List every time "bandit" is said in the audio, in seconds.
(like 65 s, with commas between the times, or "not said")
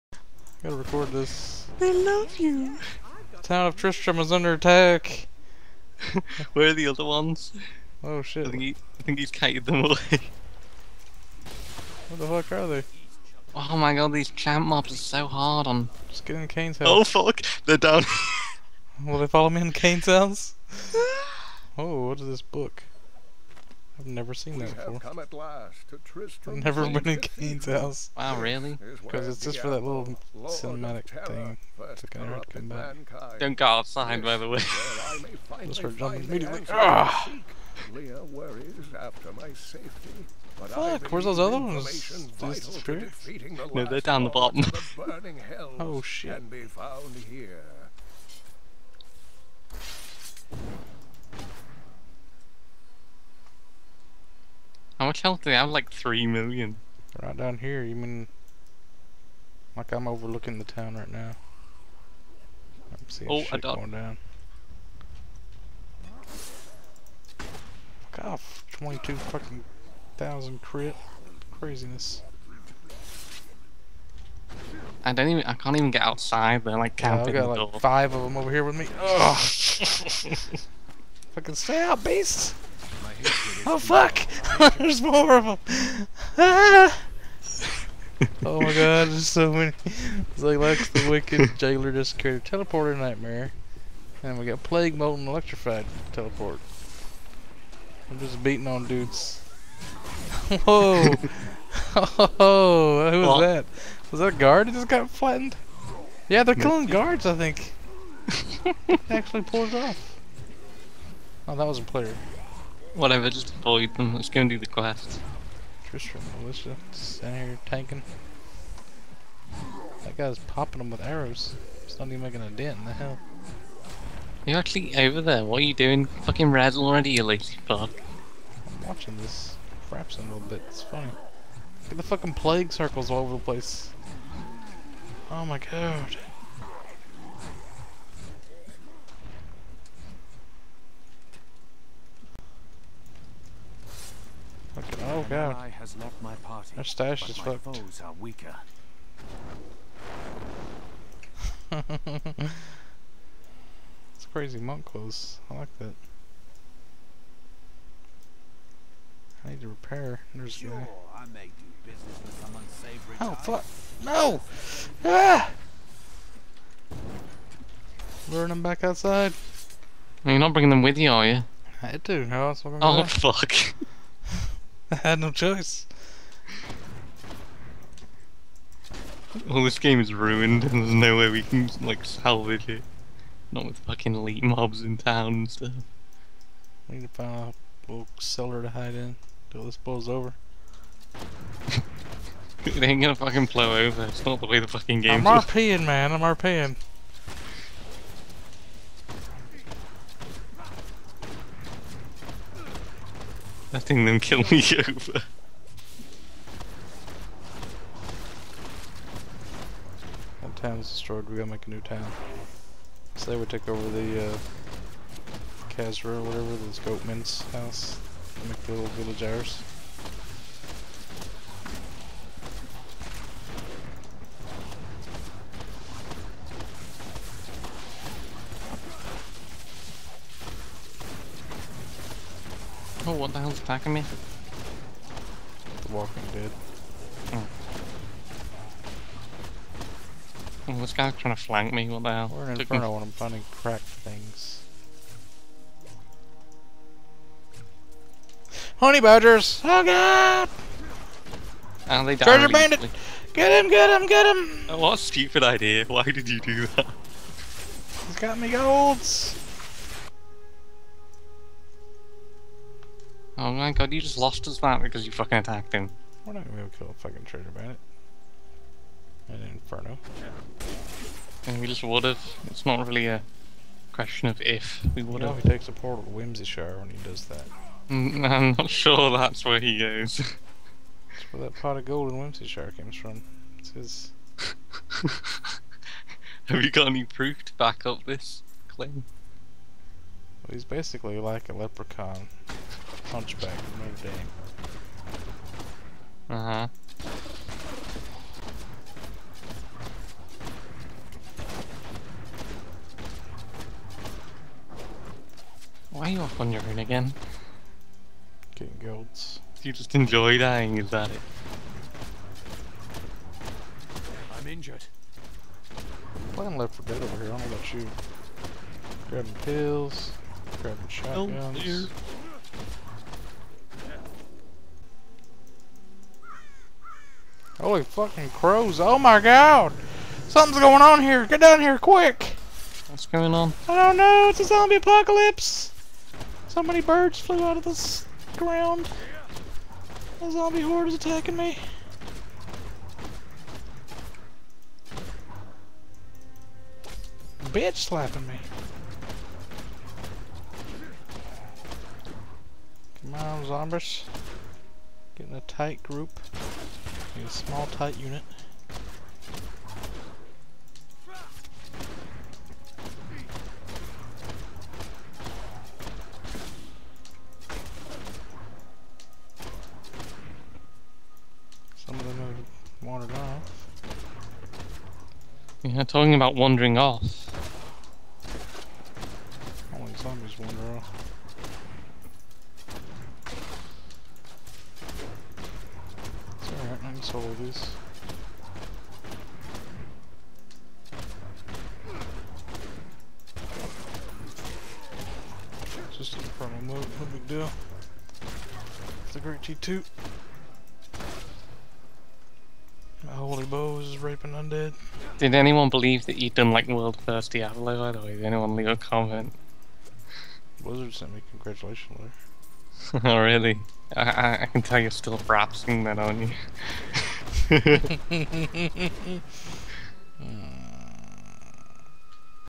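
252 s, 267 s.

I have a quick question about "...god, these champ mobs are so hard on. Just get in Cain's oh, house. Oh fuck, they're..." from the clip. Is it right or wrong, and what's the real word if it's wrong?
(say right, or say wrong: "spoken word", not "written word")
right.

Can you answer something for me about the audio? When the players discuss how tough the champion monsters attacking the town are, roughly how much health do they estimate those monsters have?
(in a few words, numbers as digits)
3 million.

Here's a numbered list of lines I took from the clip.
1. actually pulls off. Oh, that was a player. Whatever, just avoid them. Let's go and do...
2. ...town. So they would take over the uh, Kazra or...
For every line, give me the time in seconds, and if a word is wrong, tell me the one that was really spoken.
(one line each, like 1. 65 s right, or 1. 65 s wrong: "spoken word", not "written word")
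1. 109 s right
2. 211 s right.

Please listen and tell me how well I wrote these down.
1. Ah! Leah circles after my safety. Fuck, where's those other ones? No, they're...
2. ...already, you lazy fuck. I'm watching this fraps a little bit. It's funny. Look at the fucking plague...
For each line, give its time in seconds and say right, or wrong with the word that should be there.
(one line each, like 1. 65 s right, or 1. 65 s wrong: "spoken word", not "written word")
1. 36 s wrong: "worries", not "circles"
2. 126 s right.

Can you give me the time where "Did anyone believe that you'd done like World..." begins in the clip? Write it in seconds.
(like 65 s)
405 s.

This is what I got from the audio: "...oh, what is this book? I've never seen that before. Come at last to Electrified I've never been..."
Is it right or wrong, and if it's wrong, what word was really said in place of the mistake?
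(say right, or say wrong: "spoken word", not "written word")
wrong: "Tristram", not "Electrified".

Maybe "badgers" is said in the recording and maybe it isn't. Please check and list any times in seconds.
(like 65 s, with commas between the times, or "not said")
249 s.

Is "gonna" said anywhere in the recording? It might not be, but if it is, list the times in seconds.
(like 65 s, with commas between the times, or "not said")
193 s, 266 s.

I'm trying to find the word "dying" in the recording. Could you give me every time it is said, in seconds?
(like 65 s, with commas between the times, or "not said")
310 s.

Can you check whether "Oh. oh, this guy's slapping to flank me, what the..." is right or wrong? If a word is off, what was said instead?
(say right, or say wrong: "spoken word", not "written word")
wrong: "trying", not "slapping".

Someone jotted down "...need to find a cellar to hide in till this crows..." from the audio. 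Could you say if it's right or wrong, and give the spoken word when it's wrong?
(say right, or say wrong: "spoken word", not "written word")
wrong: "blows", not "crows".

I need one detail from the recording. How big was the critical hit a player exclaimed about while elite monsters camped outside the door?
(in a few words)
22 thousand.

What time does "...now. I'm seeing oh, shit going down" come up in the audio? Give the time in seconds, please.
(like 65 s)
61 s.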